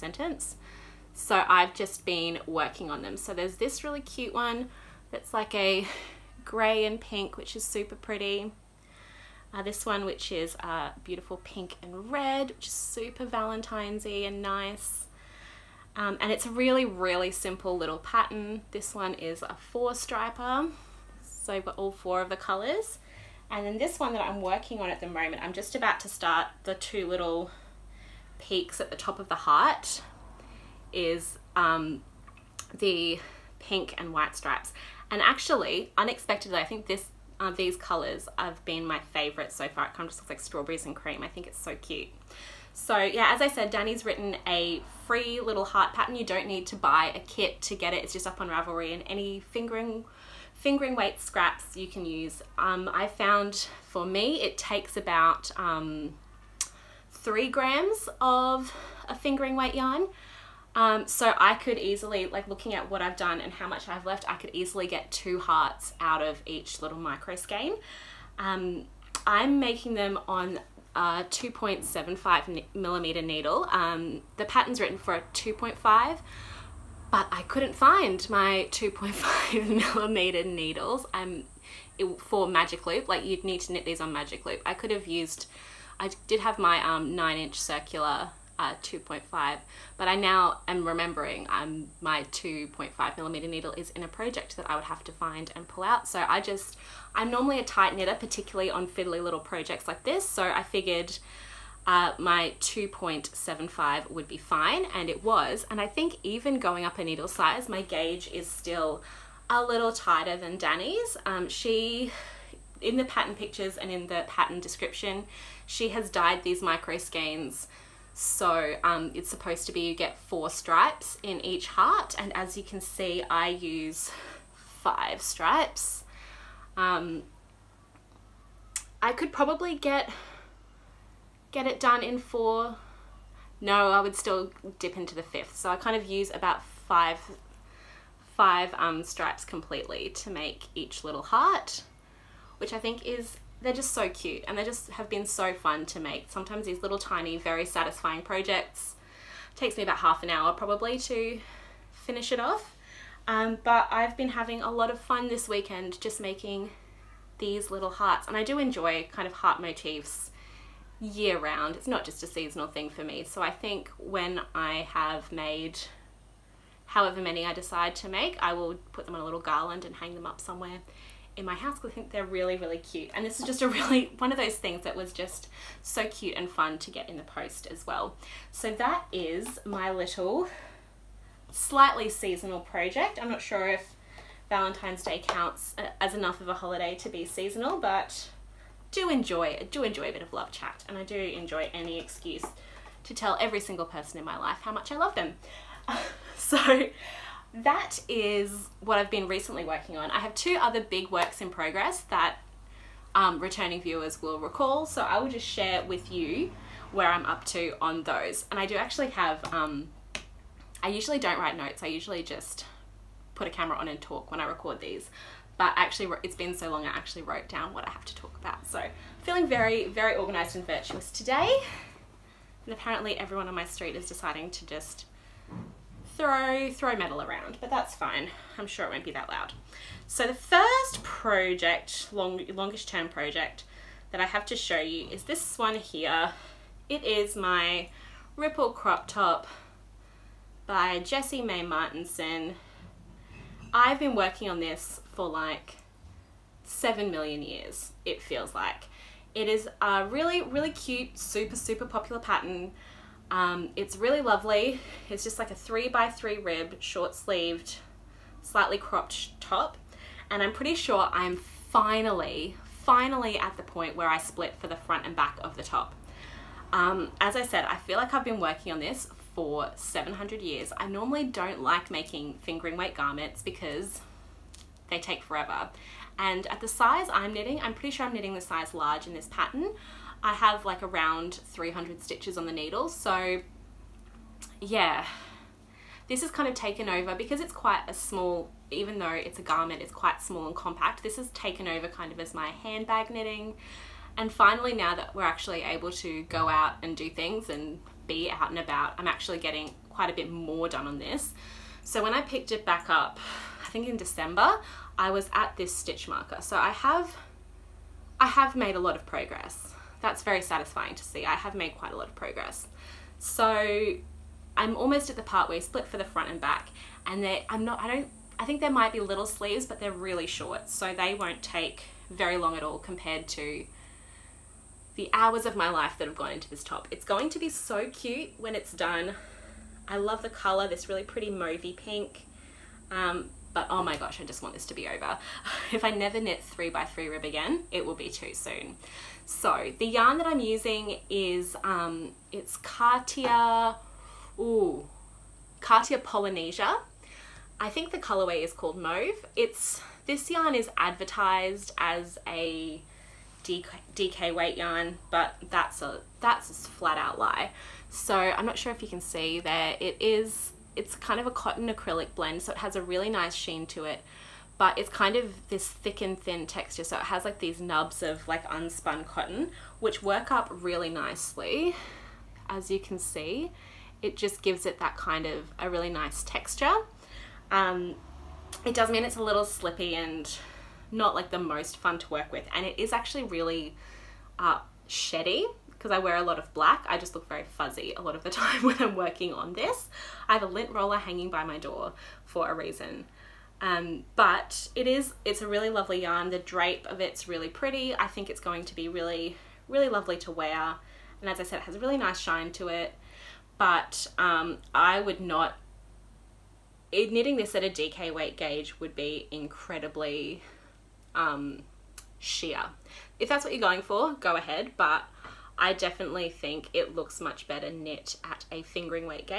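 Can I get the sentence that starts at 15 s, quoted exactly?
Um, and it's a really, really simple little pattern.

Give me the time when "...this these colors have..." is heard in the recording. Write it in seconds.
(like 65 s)
36 s.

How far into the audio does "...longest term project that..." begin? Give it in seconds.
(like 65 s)
232 s.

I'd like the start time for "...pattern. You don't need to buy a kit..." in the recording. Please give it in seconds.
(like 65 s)
45 s.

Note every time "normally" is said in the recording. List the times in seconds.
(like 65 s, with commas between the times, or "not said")
97 s, 270 s.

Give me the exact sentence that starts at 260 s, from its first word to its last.
And I'm pretty sure I'm finally, finally at the point where I split for the front and back of the top.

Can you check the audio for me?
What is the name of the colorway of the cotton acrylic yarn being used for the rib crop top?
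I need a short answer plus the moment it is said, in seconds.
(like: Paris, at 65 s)
Mauve, at 348 s.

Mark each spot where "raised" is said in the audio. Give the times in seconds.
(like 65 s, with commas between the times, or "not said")
not said.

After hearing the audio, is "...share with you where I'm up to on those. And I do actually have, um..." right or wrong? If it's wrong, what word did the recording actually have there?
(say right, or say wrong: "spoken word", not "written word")
right.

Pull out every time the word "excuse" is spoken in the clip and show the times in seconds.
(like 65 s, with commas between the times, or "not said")
191 s.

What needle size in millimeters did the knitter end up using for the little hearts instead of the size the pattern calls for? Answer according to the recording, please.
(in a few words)
2.75 millimeters.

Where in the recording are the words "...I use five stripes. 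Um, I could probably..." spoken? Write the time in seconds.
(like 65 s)
123 s.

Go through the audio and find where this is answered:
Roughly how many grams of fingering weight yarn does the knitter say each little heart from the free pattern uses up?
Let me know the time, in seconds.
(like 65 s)
57 s.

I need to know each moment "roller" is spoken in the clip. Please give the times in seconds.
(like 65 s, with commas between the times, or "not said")
390 s.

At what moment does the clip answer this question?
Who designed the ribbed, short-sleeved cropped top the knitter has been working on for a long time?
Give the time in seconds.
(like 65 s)
240 s.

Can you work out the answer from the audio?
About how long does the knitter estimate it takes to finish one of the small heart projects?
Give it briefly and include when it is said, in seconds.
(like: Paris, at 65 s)
half an hour, at 149 s.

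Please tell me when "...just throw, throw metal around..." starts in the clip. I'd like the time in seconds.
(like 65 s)
224 s.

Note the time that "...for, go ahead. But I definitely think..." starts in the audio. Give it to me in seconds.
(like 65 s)
413 s.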